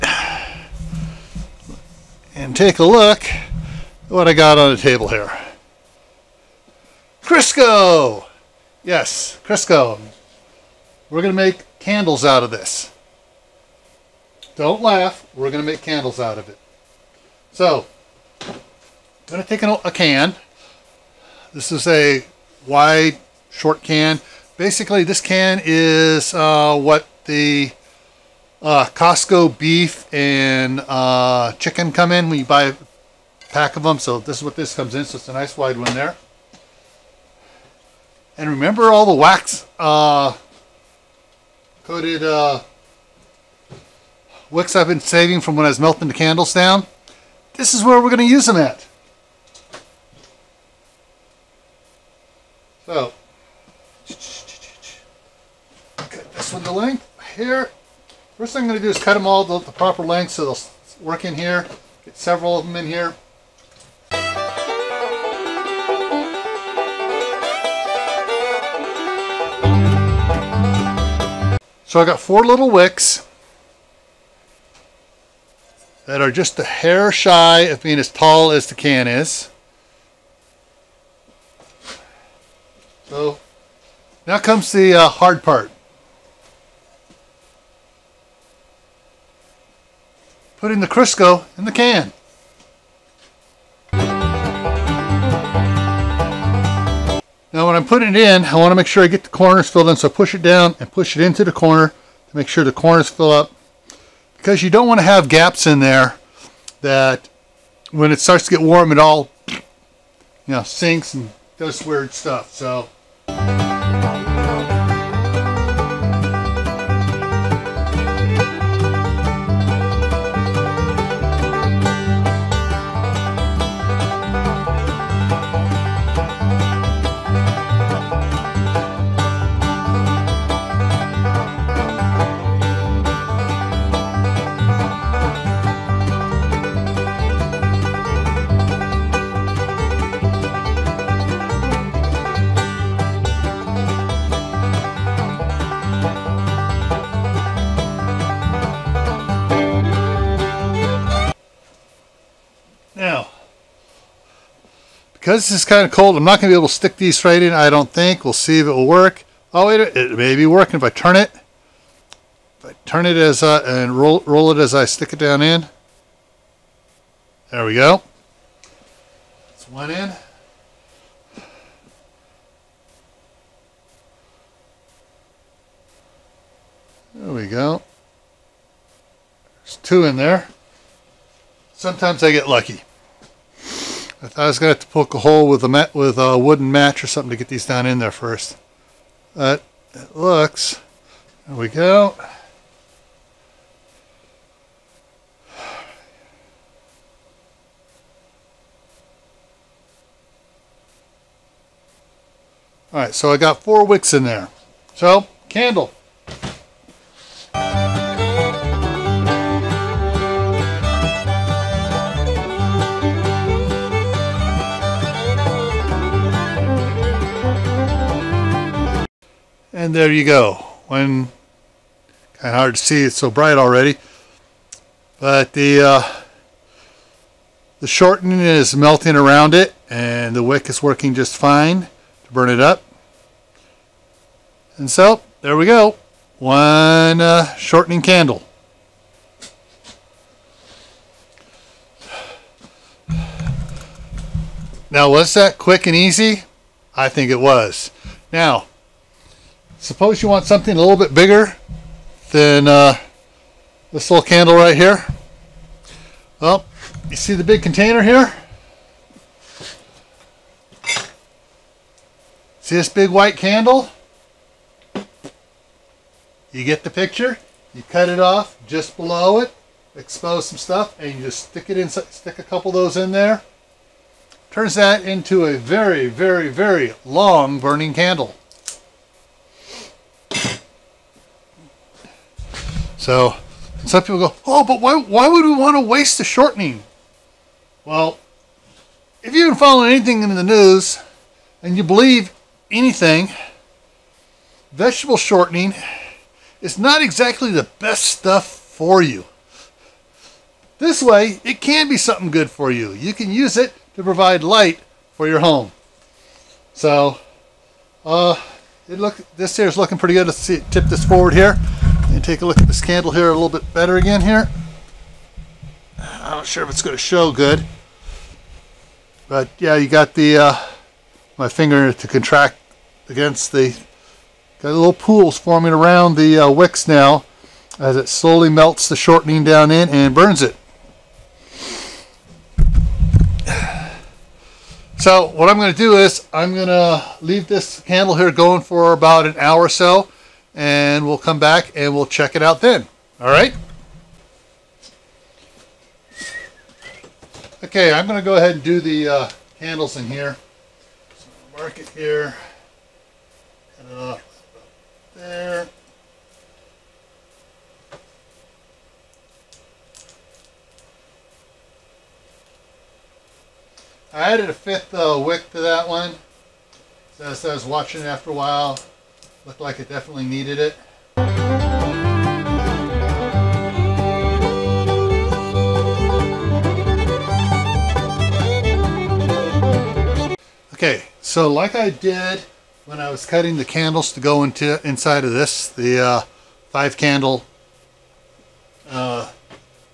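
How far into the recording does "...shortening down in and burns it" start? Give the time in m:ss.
5:28.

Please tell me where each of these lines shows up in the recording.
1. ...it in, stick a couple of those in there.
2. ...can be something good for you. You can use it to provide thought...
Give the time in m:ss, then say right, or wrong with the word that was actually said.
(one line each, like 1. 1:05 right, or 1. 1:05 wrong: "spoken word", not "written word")
1. 4:31 right
2. 5:01 wrong: "light", not "thought".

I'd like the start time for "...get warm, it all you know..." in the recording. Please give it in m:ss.
1:48.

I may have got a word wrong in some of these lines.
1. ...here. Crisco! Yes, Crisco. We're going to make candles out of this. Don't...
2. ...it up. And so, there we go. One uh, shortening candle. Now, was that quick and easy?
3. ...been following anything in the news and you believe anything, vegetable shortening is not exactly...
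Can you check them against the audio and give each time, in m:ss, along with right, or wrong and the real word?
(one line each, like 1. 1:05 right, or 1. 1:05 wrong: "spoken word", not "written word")
1. 0:05 right
2. 3:52 right
3. 4:49 right.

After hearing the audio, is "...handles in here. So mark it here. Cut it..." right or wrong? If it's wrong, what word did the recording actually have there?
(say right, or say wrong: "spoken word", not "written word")
right.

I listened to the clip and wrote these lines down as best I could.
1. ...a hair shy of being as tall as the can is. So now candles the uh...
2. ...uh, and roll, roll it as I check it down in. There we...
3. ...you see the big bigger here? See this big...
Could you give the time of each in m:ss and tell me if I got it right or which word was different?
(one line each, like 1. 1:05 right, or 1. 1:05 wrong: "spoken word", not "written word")
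1. 1:16 wrong: "comes", not "candles"
2. 2:43 wrong: "stick", not "check"
3. 4:17 wrong: "container", not "bigger".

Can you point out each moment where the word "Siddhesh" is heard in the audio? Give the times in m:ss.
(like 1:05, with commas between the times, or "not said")
not said.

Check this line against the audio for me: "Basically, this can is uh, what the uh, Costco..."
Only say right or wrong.
right.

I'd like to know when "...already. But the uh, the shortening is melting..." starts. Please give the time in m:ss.
3:43.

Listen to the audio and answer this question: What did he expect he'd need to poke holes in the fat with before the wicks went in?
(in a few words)
a wooden match.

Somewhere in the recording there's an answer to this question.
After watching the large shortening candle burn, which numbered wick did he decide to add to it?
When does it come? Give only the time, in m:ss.
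6:04.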